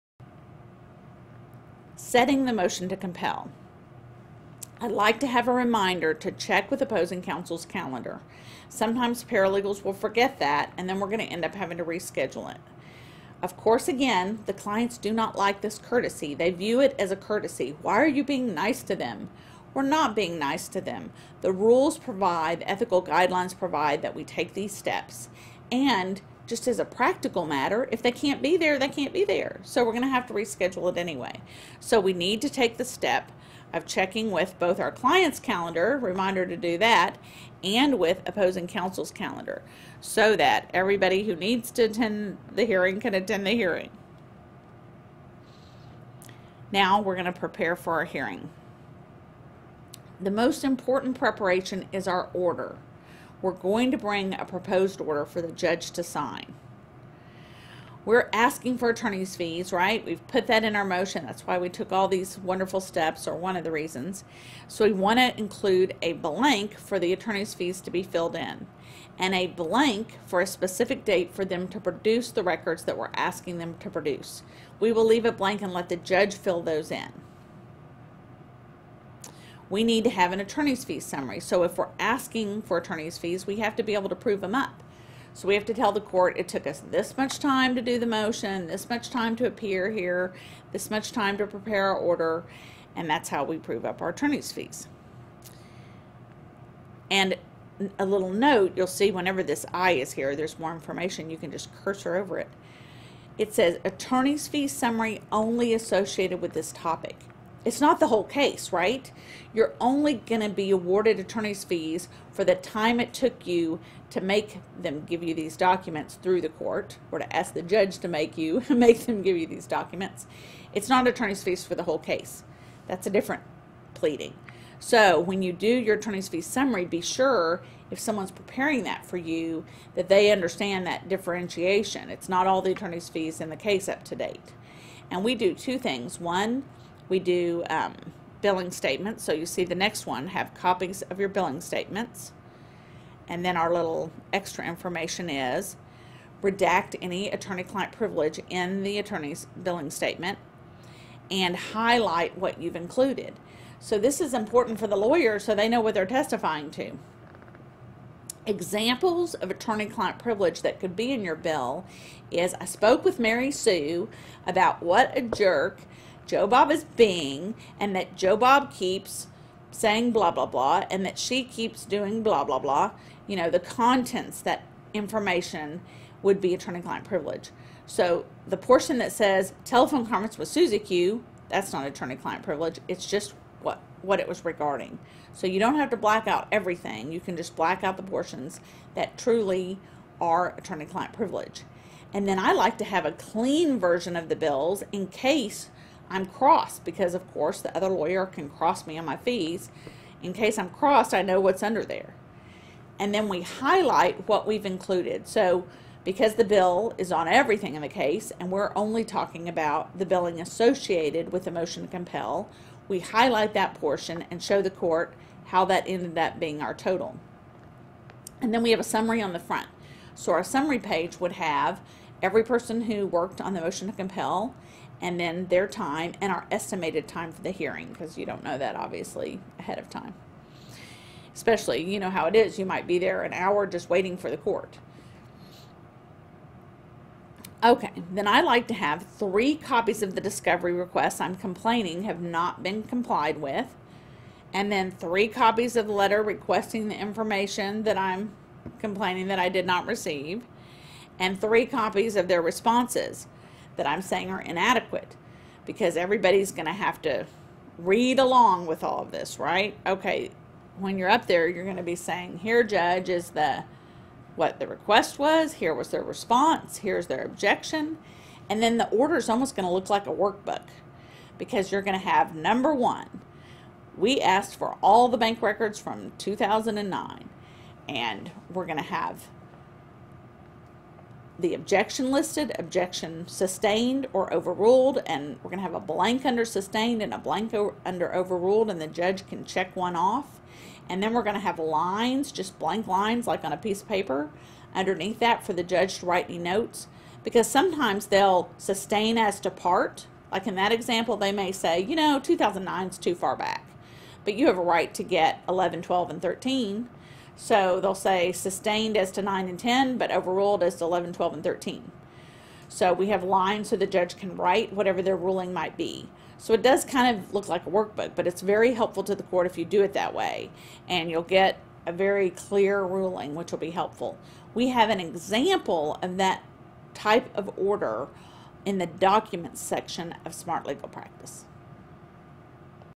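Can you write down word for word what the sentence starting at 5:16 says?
So it does kind of look like a workbook, but it's very helpful to the court if you do it that way.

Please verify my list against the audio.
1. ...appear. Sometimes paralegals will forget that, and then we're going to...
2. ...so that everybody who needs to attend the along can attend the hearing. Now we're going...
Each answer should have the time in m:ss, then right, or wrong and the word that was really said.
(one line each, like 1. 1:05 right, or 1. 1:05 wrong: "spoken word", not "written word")
1. 0:07 wrong: "calendar", not "appear"
2. 0:40 wrong: "hearing", not "along".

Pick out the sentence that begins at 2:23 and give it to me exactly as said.
And then our little extra information is redact any attorney-client privilege in the attorney's billing statement and highlight what you've included.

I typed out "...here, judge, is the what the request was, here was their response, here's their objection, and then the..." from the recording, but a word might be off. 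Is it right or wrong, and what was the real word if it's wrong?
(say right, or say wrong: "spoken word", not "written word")
right.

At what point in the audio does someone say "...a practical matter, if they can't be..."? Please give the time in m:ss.
0:26.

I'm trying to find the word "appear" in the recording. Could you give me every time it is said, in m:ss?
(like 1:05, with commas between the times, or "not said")
1:29.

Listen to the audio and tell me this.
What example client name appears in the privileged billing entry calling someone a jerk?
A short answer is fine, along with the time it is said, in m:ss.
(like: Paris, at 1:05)
Mary Sue, at 2:43.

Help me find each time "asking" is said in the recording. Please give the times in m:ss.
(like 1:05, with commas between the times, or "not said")
0:58, 1:13, 1:21.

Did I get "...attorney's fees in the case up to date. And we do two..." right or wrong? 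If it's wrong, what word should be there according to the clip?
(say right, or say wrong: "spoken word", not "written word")
right.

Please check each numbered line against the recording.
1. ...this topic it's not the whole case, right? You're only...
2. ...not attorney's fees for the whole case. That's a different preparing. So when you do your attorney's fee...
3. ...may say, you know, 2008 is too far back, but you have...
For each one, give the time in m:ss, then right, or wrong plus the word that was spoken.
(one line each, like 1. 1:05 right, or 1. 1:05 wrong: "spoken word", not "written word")
1. 1:46 right
2. 2:00 wrong: "pleading", not "preparing"
3. 5:01 wrong: "2009", not "2008".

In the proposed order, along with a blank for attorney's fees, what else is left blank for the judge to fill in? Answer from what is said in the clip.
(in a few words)
A specific date.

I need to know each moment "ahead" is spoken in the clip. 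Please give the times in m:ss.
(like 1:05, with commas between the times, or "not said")
3:49.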